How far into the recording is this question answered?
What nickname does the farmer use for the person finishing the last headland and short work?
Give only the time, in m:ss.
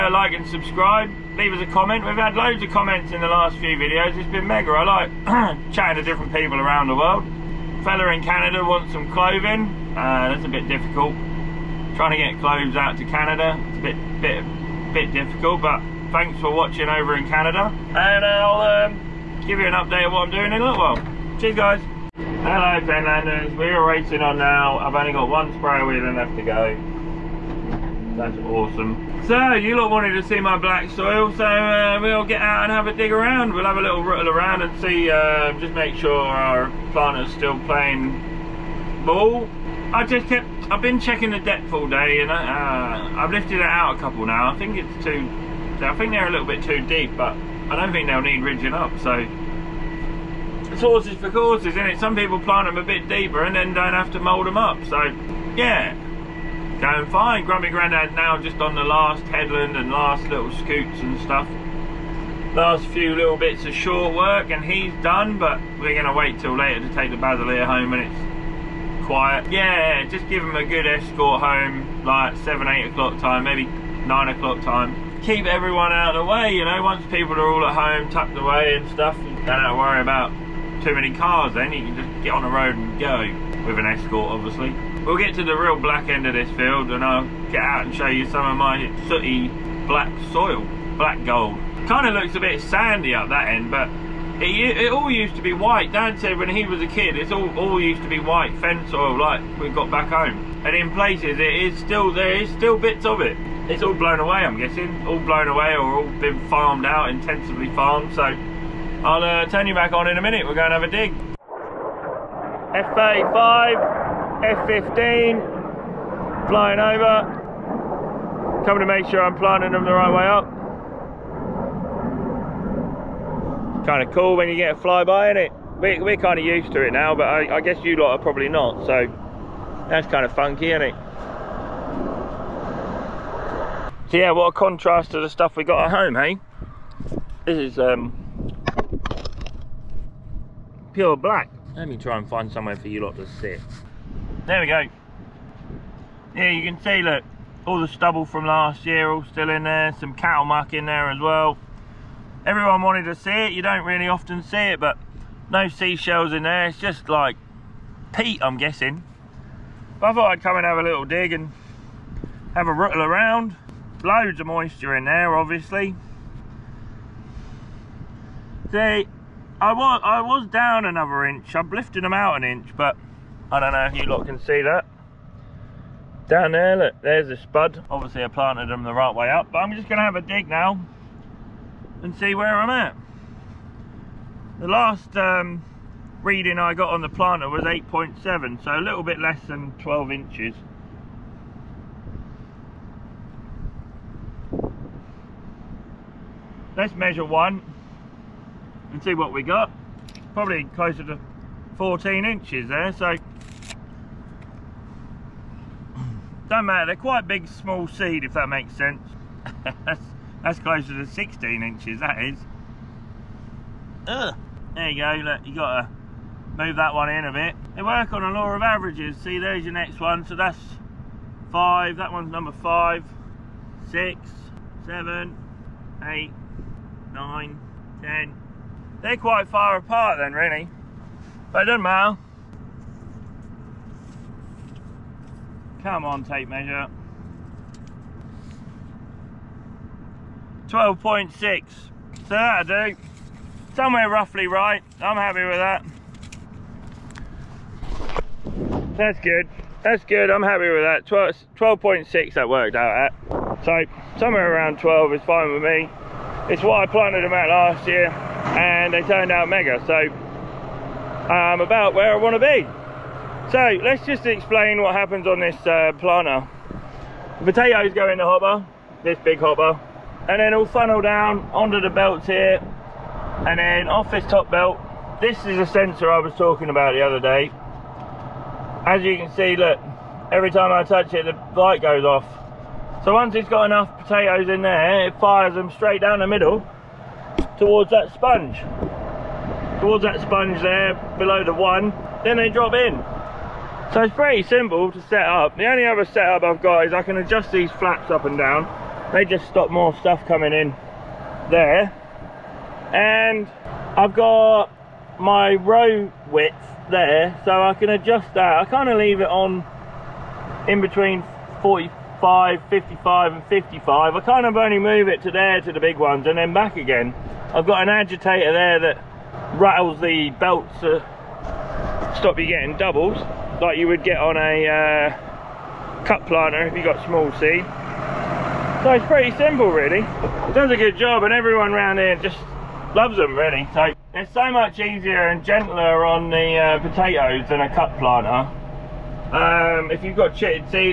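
0:57.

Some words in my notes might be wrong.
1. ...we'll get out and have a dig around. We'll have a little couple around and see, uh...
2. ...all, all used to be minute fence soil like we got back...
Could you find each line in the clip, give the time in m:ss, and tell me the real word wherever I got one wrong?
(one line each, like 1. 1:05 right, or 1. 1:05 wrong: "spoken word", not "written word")
1. 0:31 wrong: "rattle", not "couple"
2. 1:37 wrong: "white", not "minute".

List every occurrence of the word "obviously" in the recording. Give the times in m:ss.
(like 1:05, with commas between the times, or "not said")
1:24, 2:45, 2:57.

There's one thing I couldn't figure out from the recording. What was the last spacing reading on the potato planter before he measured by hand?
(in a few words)
8.7.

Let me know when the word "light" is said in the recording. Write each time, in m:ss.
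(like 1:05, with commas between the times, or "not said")
4:41.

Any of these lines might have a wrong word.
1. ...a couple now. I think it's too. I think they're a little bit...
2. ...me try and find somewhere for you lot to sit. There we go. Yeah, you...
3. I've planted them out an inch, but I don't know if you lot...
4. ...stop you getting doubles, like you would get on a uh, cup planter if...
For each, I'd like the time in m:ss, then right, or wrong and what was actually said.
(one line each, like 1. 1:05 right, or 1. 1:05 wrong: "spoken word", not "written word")
1. 0:43 right
2. 2:21 right
3. 2:51 wrong: "lifted", not "planted"
4. 5:22 right.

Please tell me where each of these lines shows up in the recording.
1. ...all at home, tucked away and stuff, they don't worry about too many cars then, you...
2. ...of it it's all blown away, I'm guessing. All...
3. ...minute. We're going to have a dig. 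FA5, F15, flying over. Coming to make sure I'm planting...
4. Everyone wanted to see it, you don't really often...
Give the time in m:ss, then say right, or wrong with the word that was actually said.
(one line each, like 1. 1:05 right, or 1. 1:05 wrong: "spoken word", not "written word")
1. 1:17 right
2. 1:43 right
3. 1:50 right
4. 2:32 right.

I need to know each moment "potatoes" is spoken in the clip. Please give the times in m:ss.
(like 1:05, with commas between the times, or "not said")
4:27, 4:44, 5:36.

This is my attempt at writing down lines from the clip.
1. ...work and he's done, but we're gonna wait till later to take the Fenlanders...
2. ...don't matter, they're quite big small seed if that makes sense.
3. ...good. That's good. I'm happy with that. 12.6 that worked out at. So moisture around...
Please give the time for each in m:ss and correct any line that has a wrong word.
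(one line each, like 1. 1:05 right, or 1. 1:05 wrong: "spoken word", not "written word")
1. 1:04 wrong: "Baselier", not "Fenlanders"
2. 3:26 right
3. 4:09 wrong: "somewhere", not "moisture".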